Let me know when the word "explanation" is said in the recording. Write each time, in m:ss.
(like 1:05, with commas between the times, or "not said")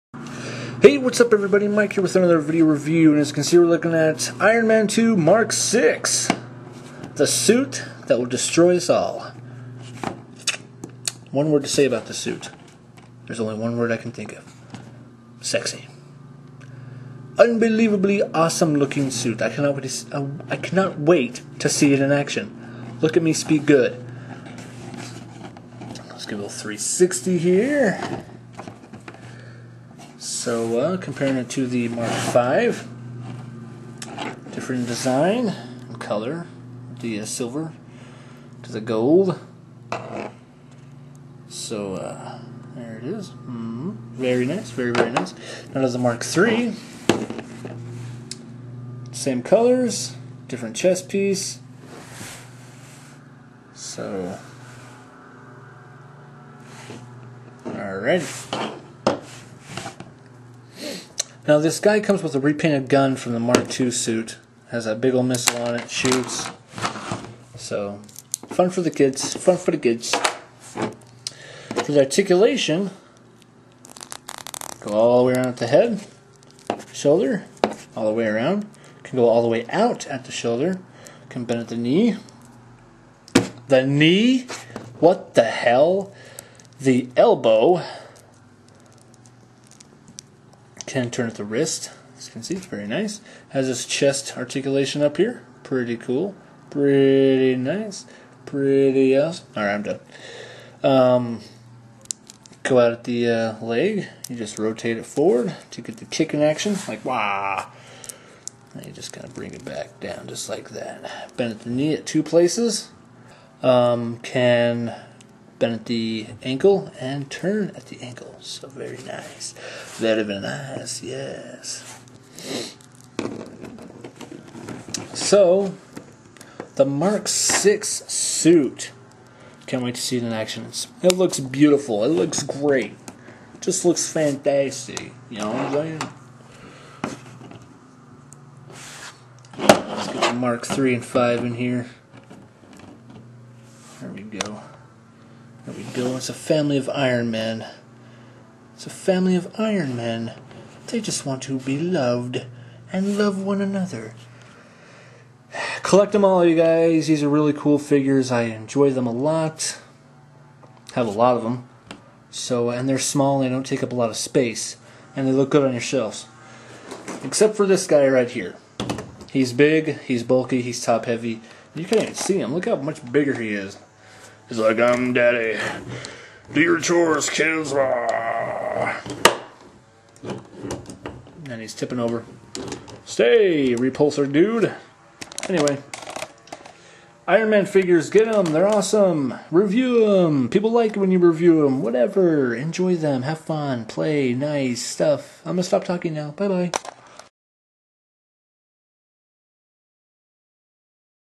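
not said.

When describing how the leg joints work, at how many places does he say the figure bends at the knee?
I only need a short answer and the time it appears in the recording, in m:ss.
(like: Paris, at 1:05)
2, at 1:52.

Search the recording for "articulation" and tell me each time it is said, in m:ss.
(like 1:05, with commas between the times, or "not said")
1:12, 1:34.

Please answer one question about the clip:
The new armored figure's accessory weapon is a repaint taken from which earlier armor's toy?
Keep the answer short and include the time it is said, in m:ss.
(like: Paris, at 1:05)
Mark II, at 1:03.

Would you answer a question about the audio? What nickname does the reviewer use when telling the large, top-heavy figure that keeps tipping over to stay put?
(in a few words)
repulsor dude.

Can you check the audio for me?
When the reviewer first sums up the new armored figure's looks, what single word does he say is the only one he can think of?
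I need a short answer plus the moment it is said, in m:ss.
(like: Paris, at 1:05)
Sexy, at 0:15.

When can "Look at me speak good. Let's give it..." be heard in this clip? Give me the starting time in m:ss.
0:23.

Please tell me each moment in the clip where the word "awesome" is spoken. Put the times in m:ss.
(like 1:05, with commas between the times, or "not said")
0:18, 1:39, 3:08.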